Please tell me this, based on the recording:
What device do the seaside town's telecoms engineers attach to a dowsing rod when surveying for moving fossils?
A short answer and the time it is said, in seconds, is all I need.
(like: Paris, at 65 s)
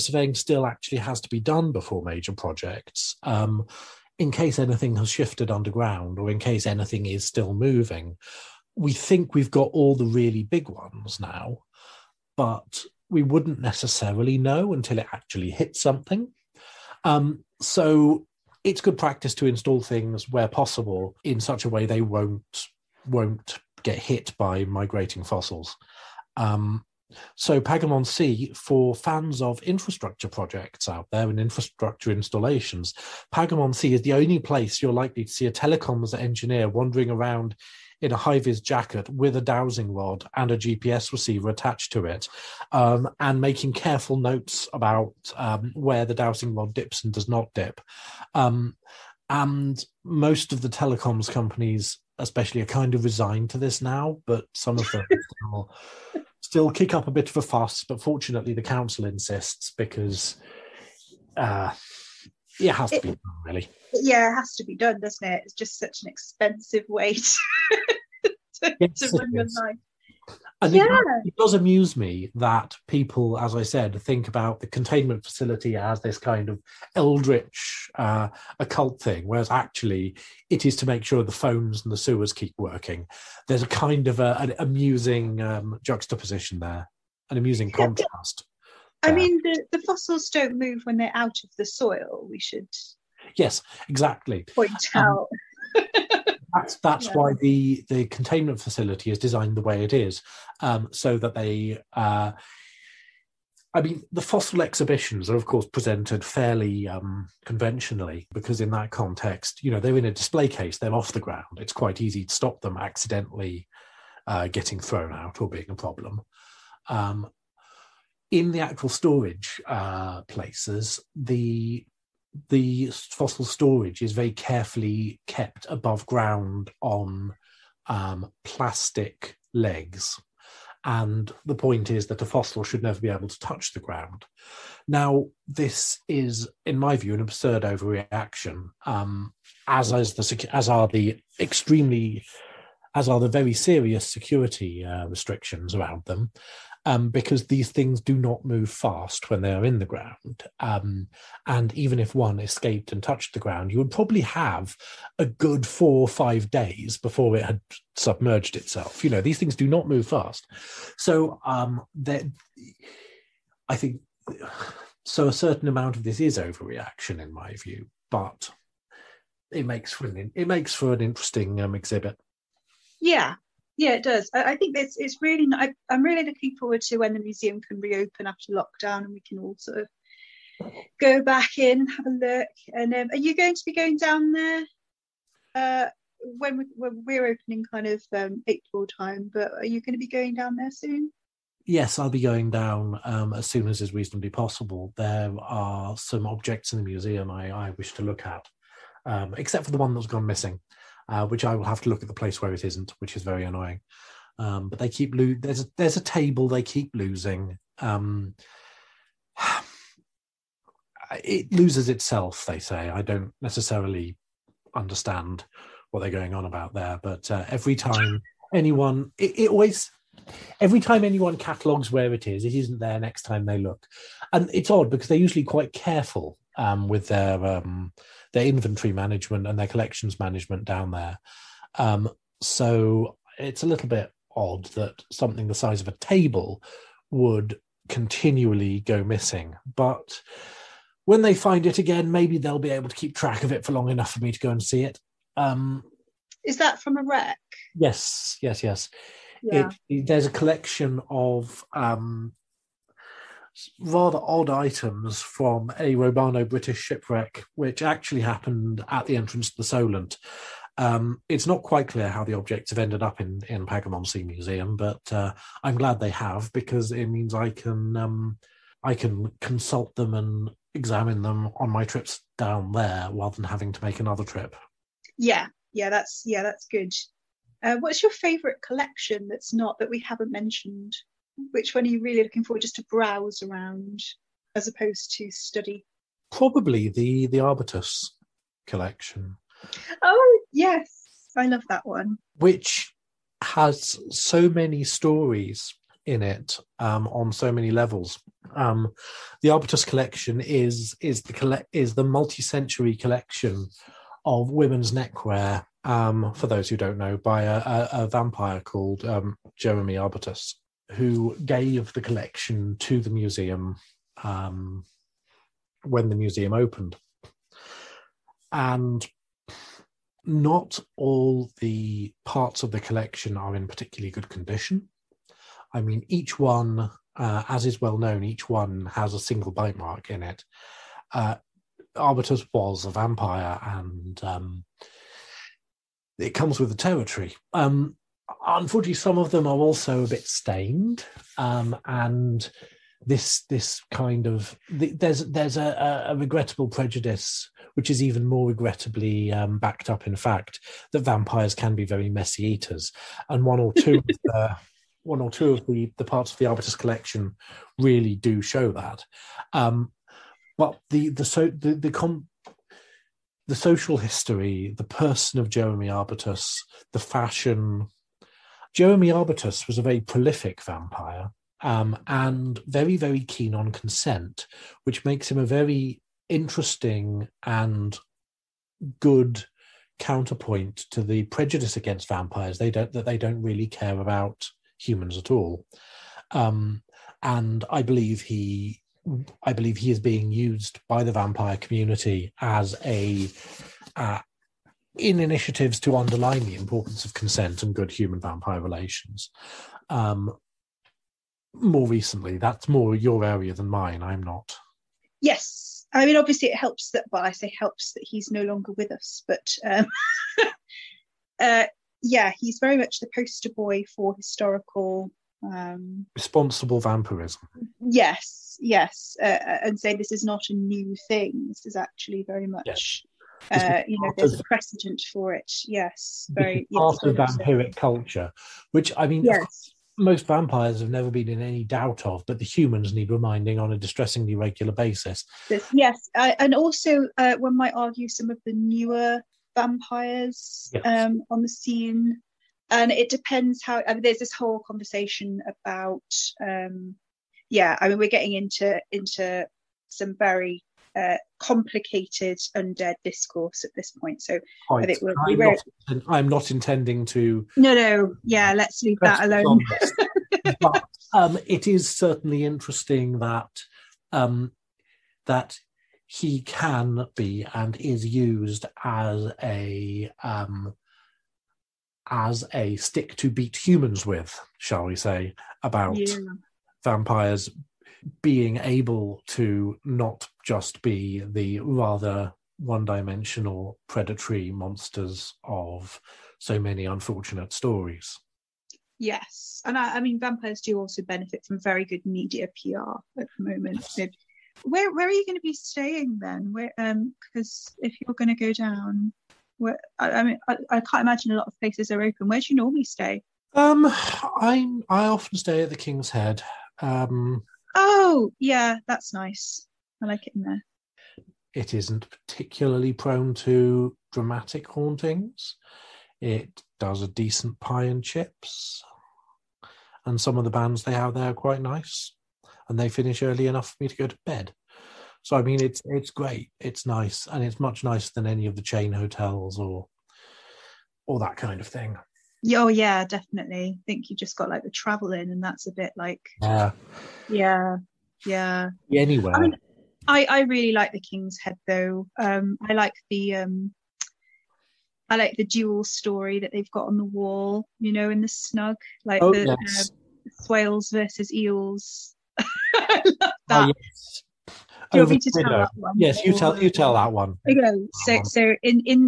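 GPS receiver, at 40 s.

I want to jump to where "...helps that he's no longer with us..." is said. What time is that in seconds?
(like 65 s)
407 s.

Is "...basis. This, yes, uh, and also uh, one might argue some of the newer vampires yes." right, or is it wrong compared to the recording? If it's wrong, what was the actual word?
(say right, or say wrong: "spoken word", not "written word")
right.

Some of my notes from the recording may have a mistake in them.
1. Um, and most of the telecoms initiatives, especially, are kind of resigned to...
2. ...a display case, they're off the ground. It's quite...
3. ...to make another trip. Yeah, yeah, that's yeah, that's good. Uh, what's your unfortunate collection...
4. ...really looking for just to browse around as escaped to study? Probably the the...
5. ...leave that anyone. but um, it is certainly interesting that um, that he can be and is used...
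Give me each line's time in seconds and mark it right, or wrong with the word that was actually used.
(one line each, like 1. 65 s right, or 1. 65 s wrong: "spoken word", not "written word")
1. 48 s wrong: "companies", not "initiatives"
2. 110 s right
3. 273 s wrong: "favourite", not "unfortunate"
4. 282 s wrong: "opposed", not "escaped"
5. 458 s wrong: "alone", not "anyone".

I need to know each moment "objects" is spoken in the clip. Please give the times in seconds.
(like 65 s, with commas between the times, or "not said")
196 s, 262 s.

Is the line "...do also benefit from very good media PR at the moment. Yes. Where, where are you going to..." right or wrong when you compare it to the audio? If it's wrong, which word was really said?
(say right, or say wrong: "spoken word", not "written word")
right.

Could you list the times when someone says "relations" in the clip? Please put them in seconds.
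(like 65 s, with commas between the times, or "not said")
398 s.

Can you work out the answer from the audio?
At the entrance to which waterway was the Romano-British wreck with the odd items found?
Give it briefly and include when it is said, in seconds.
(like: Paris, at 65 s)
The Solent, at 259 s.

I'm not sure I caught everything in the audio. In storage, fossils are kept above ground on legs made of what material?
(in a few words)
Plastic.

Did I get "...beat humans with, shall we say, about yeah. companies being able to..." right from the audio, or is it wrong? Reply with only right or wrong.
wrong.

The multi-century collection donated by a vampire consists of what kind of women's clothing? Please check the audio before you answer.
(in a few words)
Neckwear.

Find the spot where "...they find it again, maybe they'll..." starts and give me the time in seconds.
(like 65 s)
241 s.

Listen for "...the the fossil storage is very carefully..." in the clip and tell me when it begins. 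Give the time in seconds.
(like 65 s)
121 s.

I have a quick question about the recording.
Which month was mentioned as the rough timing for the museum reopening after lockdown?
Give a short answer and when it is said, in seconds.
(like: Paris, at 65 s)
April, at 188 s.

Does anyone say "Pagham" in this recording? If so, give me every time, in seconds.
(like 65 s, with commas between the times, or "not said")
27 s, 33 s, 263 s.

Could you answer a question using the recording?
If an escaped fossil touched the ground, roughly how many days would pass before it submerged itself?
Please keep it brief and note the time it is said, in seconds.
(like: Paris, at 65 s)
4 or 5 days, at 155 s.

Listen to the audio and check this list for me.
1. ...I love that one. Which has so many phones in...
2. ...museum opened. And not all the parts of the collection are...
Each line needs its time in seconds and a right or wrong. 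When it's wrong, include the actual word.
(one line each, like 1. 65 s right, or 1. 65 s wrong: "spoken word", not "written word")
1. 291 s wrong: "stories", not "phones"
2. 316 s right.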